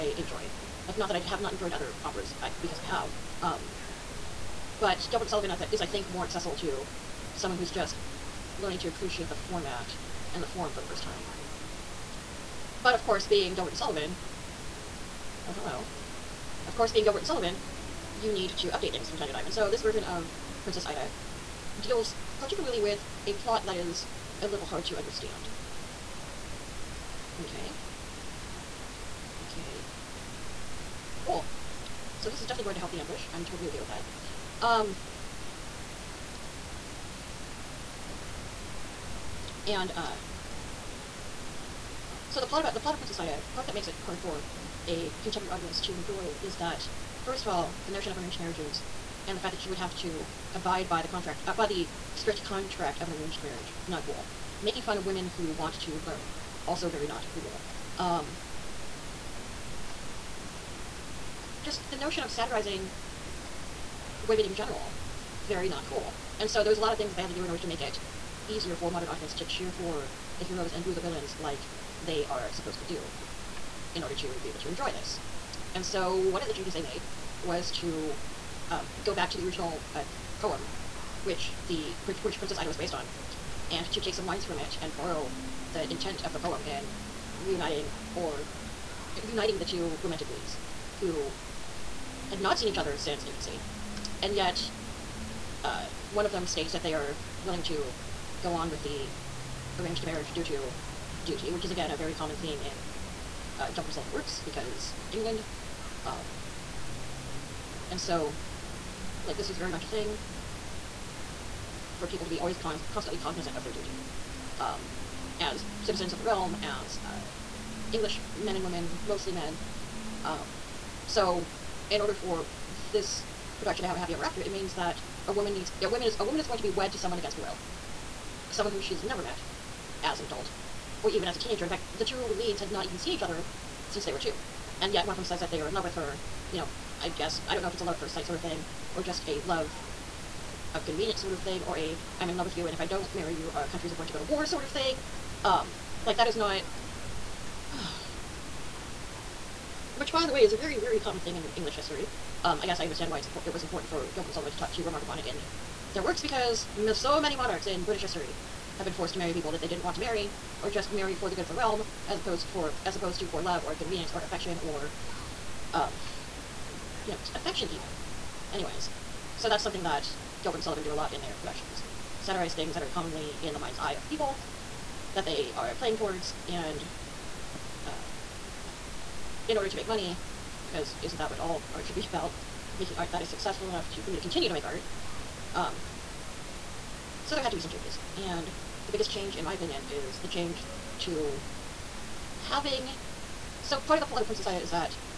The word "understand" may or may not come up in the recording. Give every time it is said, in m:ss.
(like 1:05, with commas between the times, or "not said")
0:24, 2:32.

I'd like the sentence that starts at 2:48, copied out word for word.
Anyways, so that's something that Gilbert and Sullivan do a lot in their productions.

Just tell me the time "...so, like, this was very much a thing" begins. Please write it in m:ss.
1:47.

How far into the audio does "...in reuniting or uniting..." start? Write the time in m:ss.
1:26.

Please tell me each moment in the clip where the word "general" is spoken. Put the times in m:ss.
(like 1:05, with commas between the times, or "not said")
1:04.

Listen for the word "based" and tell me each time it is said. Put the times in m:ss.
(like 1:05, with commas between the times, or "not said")
1:22.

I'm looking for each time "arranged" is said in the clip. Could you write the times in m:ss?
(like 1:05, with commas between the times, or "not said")
0:48, 0:53, 1:39.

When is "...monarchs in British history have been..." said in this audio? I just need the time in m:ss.
2:37.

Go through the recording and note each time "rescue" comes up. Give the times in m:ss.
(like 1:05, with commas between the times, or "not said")
not said.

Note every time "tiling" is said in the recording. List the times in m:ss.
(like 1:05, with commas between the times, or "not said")
not said.